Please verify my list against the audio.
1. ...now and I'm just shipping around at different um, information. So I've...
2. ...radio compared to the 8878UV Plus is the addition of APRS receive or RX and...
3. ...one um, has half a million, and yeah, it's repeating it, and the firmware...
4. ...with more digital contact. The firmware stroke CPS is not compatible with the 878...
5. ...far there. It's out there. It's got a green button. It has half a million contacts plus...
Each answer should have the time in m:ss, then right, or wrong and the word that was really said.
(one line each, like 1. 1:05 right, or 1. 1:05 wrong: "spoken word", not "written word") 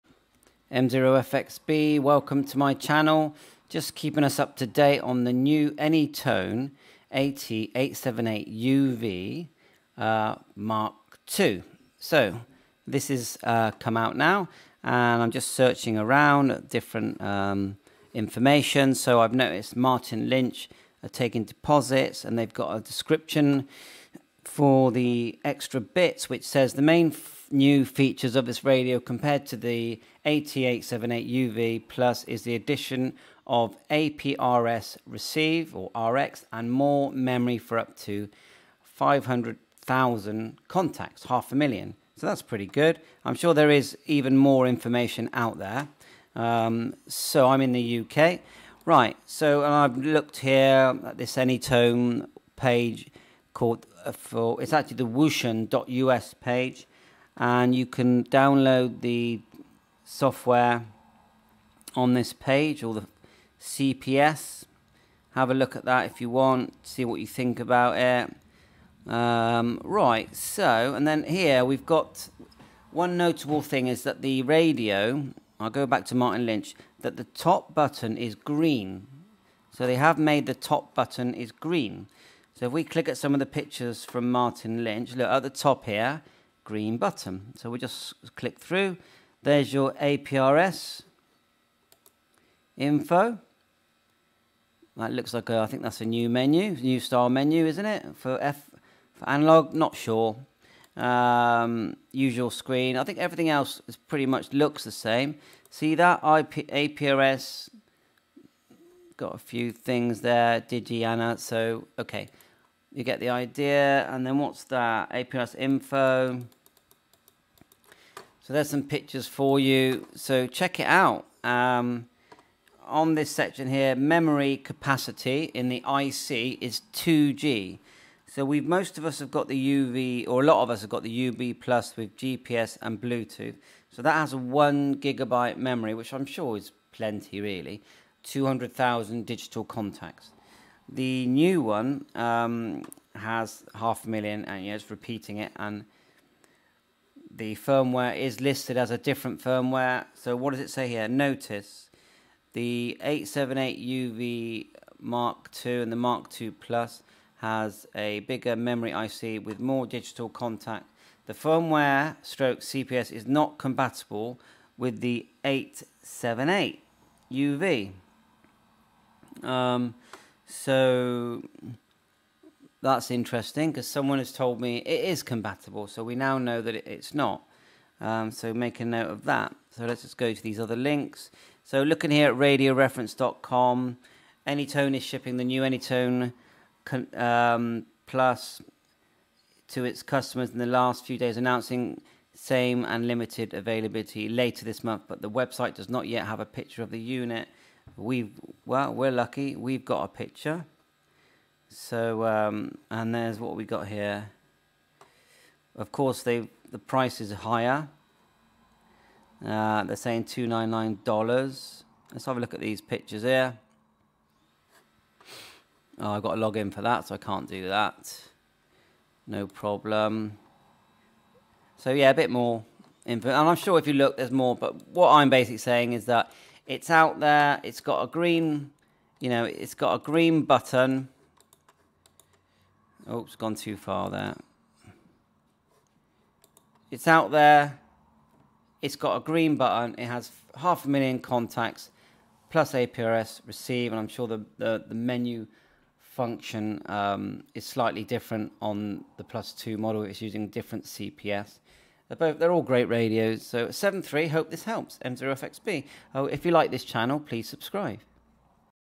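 1. 0:14 wrong: "searching", not "shipping"
2. 0:28 right
3. 2:21 right
4. 2:39 right
5. 3:53 right.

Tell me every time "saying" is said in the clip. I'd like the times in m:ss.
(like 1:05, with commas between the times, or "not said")
3:29, 3:45.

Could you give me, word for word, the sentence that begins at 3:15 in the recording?
But the website does not yet have a picture of the unit.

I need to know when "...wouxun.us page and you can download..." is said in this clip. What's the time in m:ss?
0:55.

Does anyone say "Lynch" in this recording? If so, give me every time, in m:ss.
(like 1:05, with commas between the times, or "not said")
0:20, 1:16, 1:24.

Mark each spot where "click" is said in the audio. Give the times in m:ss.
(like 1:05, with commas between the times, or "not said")
1:22, 1:28.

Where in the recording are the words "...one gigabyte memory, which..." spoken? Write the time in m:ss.
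2:14.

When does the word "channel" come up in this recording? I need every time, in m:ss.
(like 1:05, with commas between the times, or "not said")
0:02, 4:16.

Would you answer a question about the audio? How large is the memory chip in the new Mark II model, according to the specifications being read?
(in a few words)
2G.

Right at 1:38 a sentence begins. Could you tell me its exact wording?
For F for analog, not sure.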